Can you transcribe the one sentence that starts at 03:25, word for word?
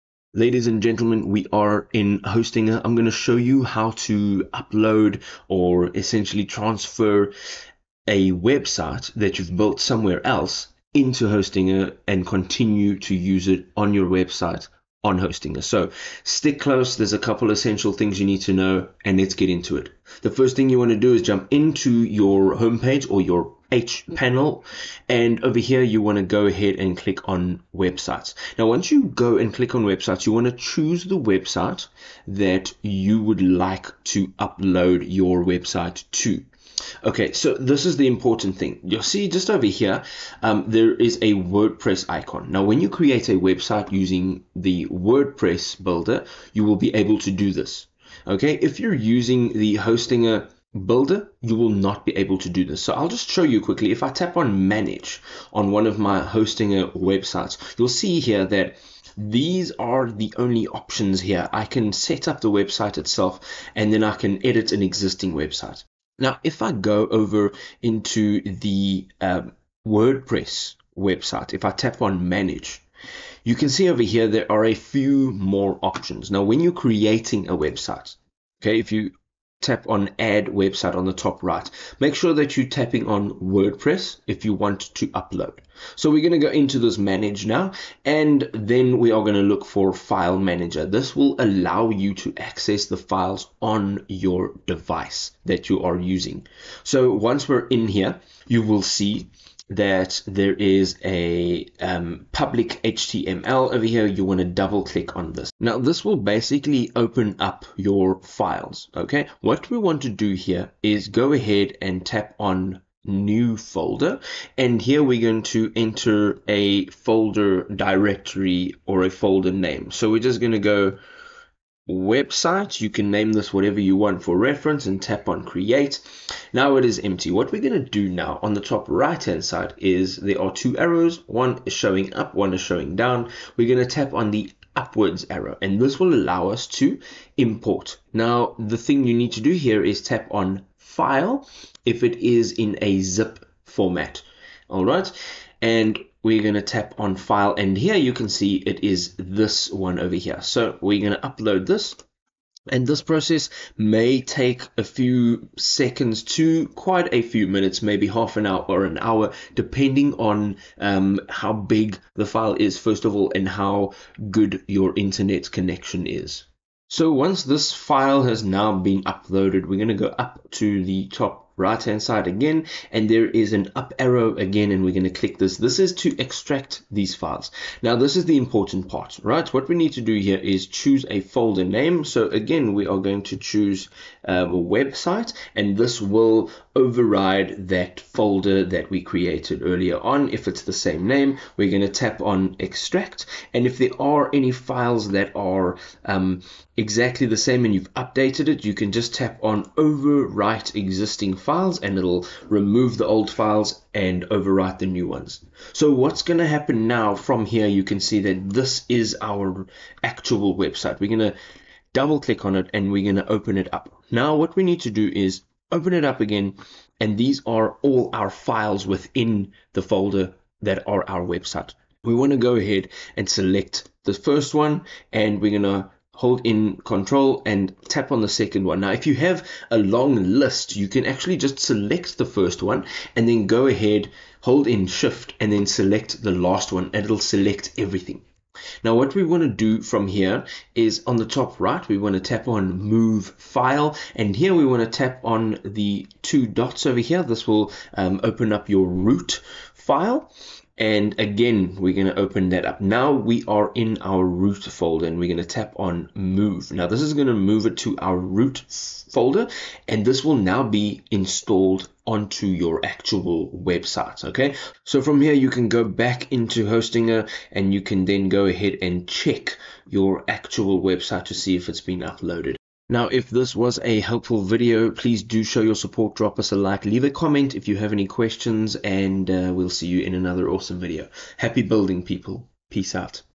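So what's going to happen now from here, you can see that this is our actual website.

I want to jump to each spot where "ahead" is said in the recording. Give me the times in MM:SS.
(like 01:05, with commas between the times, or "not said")
00:26, 01:51, 03:42, 03:53, 04:28.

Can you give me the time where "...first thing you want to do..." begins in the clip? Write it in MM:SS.
00:20.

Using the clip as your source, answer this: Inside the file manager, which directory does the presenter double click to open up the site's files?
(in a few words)
public HTML.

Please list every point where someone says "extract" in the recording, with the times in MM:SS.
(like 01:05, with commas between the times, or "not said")
02:56, 03:12.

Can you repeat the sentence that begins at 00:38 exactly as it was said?
You'll see just over here, um, there is a WordPress icon.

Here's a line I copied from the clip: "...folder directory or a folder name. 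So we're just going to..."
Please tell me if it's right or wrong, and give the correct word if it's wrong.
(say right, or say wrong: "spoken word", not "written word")
right.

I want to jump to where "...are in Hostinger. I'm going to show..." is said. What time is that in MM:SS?
00:01.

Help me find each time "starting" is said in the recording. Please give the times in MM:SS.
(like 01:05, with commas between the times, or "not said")
not said.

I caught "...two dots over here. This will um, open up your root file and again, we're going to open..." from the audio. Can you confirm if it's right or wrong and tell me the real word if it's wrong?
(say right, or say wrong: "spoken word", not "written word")
right.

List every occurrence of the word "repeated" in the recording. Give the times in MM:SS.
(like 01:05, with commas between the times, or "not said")
not said.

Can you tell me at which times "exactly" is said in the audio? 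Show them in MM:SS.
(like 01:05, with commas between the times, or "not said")
03:16.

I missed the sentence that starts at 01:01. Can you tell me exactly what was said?
I can set up the website itself and then I can edit an existing website.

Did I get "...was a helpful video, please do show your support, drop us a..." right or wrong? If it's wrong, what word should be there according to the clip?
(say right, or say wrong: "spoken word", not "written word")
right.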